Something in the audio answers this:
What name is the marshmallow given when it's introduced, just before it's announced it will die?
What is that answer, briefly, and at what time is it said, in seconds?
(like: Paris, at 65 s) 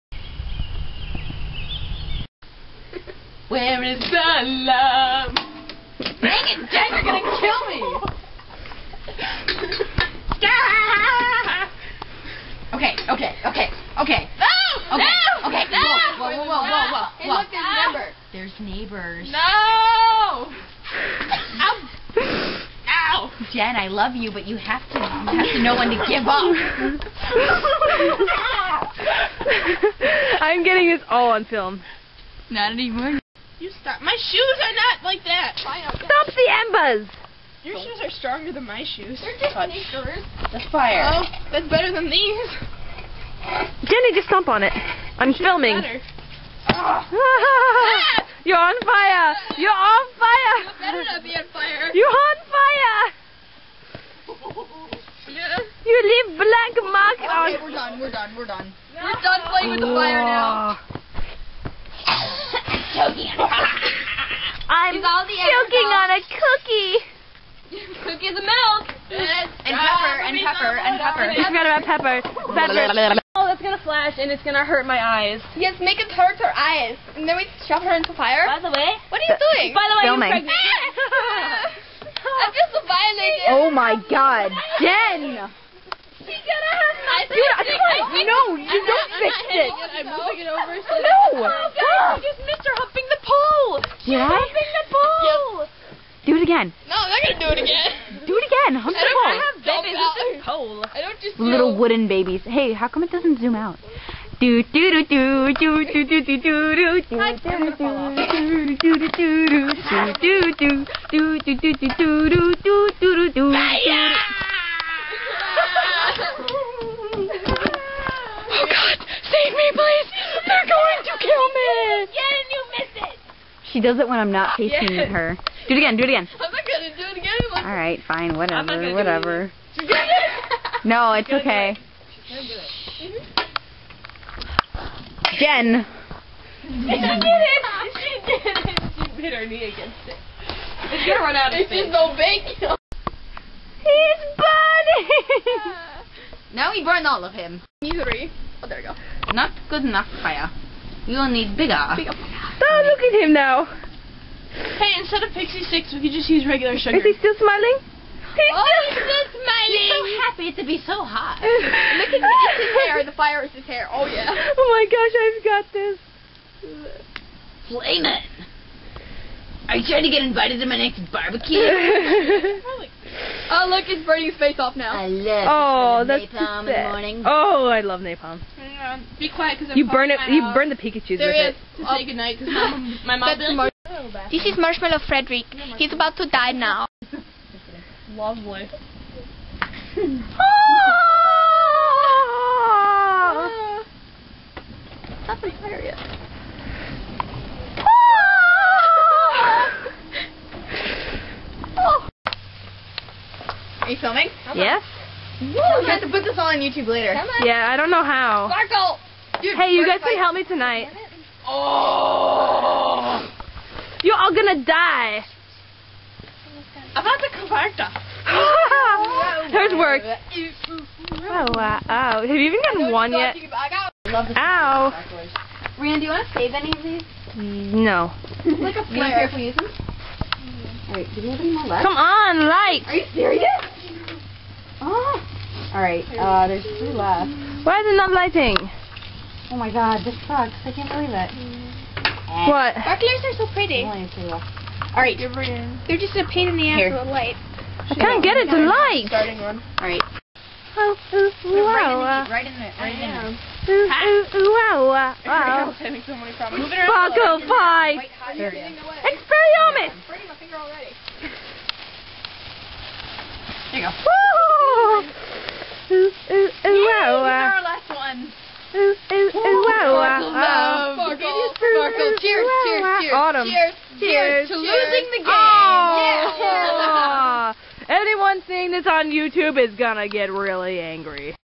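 Frederick, at 185 s.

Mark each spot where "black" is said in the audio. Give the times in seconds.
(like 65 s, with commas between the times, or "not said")
56 s.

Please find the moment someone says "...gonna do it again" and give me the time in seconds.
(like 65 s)
126 s.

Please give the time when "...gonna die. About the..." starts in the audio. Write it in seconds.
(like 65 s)
214 s.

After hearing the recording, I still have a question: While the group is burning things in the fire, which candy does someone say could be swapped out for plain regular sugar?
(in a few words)
Pixy Stix.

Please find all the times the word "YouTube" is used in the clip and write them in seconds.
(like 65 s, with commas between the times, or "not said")
206 s, 279 s.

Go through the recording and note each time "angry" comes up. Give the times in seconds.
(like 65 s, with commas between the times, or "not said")
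280 s.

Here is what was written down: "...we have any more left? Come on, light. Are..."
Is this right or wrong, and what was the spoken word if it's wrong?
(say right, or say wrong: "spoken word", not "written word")
right.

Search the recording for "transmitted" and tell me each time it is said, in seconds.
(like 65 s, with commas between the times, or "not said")
not said.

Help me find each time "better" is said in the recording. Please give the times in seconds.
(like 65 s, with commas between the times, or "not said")
41 s, 50 s.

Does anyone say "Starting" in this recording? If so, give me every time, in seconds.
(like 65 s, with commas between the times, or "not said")
249 s.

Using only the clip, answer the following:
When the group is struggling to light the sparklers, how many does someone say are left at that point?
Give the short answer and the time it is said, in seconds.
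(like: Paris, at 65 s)
2, at 236 s.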